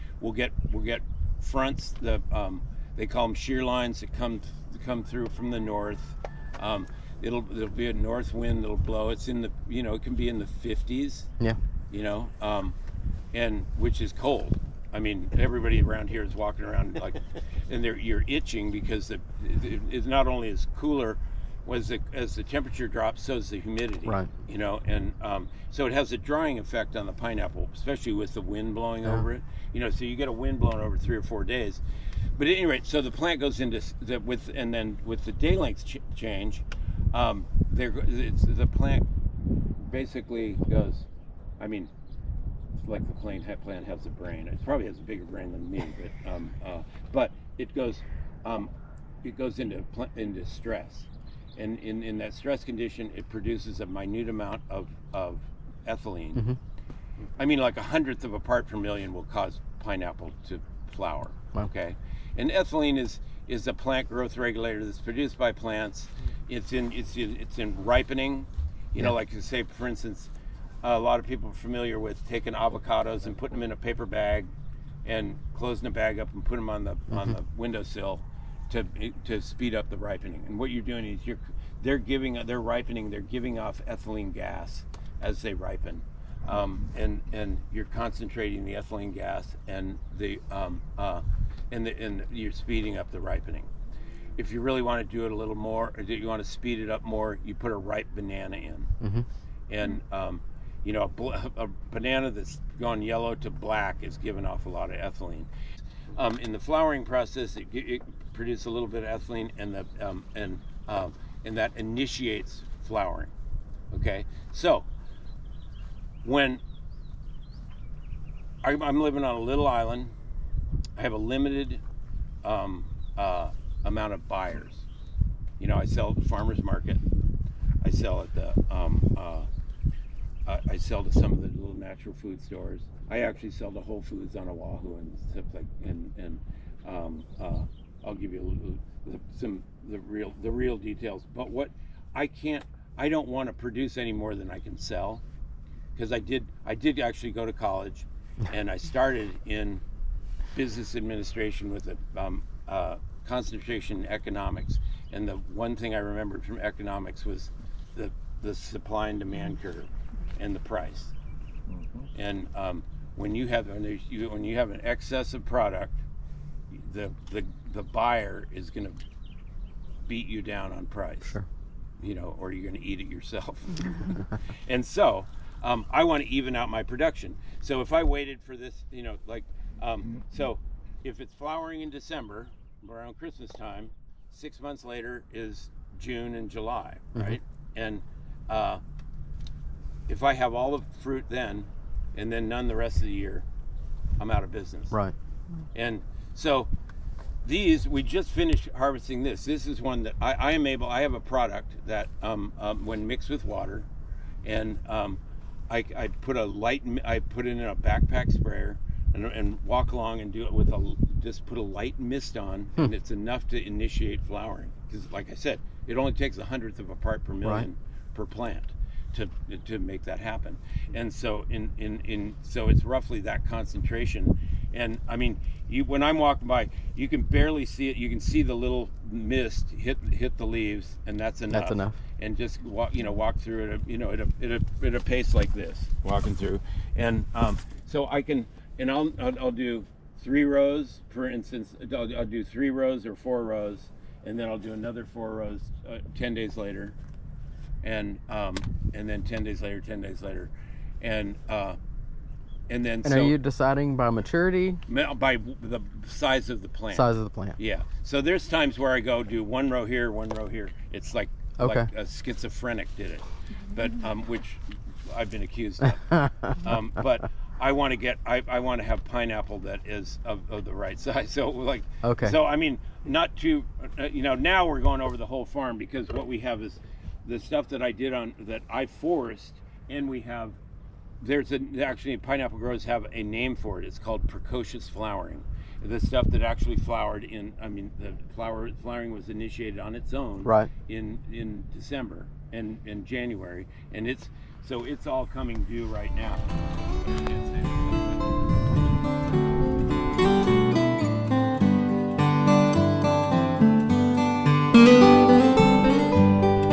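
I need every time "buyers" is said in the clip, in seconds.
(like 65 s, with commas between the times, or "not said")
124 s, 167 s.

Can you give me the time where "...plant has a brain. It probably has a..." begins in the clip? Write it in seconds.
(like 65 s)
43 s.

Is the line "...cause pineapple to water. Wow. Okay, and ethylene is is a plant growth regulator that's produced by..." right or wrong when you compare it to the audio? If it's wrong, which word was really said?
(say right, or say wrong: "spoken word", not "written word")
wrong: "flower", not "water".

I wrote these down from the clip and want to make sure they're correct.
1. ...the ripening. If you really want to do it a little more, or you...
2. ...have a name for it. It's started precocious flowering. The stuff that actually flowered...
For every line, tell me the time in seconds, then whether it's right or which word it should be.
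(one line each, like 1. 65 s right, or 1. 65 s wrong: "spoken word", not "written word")
1. 93 s right
2. 282 s wrong: "called", not "started".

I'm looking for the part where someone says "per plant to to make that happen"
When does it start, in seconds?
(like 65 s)
218 s.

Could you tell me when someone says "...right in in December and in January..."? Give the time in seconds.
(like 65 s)
290 s.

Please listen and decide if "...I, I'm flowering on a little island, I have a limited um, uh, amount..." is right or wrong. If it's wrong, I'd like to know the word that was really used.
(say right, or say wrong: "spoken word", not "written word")
wrong: "living", not "flowering".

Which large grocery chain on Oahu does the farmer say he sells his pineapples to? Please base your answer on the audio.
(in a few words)
Whole Foods.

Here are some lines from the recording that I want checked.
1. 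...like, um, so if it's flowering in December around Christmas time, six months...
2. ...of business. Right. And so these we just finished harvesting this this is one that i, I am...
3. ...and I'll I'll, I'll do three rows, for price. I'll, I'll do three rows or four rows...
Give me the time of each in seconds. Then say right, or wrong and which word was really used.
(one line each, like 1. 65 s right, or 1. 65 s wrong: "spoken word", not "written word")
1. 179 s right
2. 194 s right
3. 238 s wrong: "instance", not "price".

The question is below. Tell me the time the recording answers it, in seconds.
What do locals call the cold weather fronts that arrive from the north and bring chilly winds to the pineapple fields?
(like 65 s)
3 s.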